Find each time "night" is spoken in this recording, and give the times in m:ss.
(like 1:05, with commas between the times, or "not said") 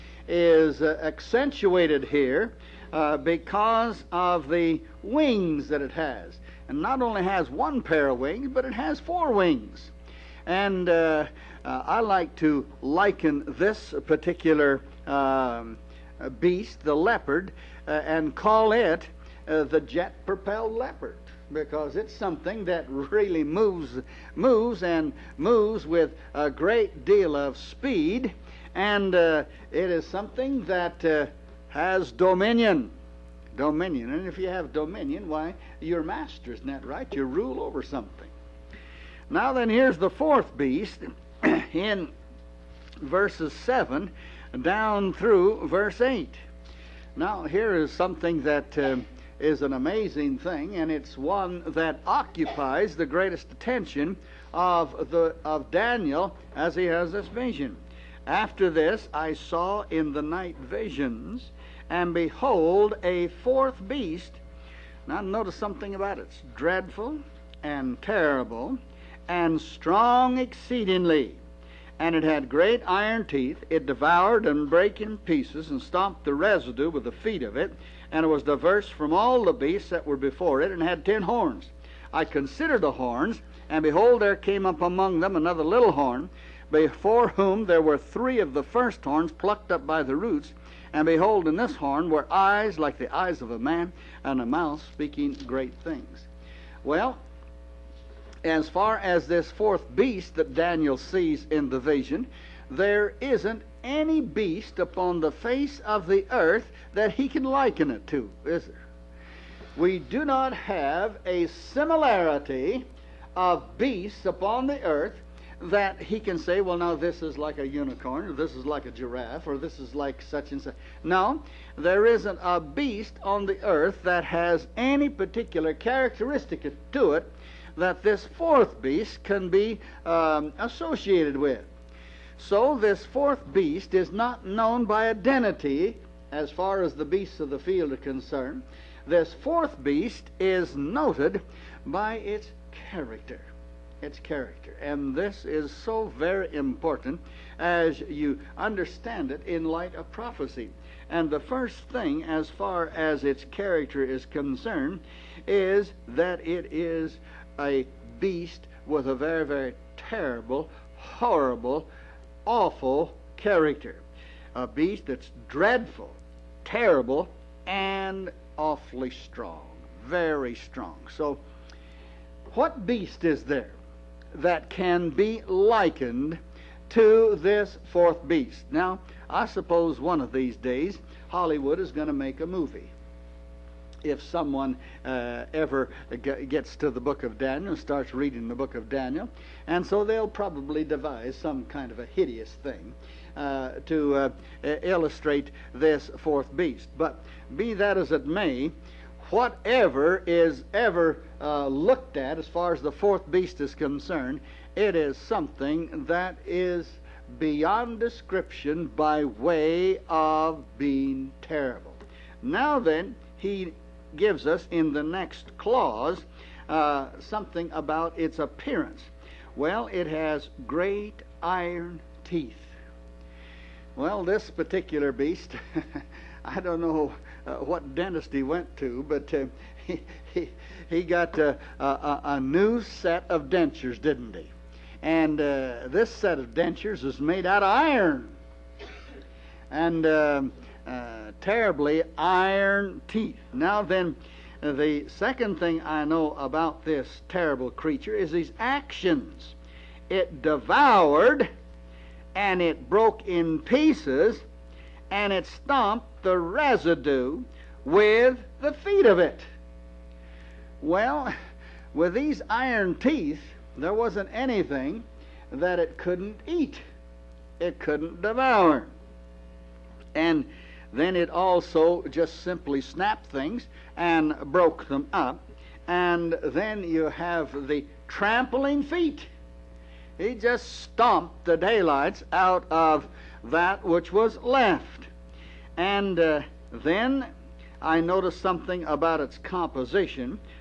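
1:00.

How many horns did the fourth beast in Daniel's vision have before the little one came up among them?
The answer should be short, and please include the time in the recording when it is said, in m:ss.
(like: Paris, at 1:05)
10, at 1:21.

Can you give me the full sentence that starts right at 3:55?
And uh, this set of dentures is made out of iron.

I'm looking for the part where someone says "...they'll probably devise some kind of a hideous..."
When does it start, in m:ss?
3:10.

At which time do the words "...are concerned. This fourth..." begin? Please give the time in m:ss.
2:17.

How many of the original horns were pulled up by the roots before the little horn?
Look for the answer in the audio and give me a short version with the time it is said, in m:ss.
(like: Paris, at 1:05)
3, at 1:27.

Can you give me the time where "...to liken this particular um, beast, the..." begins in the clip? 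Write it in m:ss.
0:12.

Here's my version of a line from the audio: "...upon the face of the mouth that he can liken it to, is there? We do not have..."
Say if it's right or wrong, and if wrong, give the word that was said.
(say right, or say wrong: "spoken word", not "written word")
wrong: "earth", not "mouth".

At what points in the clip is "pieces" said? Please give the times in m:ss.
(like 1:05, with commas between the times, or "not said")
1:15, 4:13.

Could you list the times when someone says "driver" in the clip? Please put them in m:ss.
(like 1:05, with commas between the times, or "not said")
not said.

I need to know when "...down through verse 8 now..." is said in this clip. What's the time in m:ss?
0:44.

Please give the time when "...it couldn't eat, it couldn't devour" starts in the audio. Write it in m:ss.
4:25.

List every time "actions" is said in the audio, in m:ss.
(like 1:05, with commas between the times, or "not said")
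4:08.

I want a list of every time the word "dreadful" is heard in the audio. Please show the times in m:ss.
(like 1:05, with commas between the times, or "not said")
1:06, 2:45.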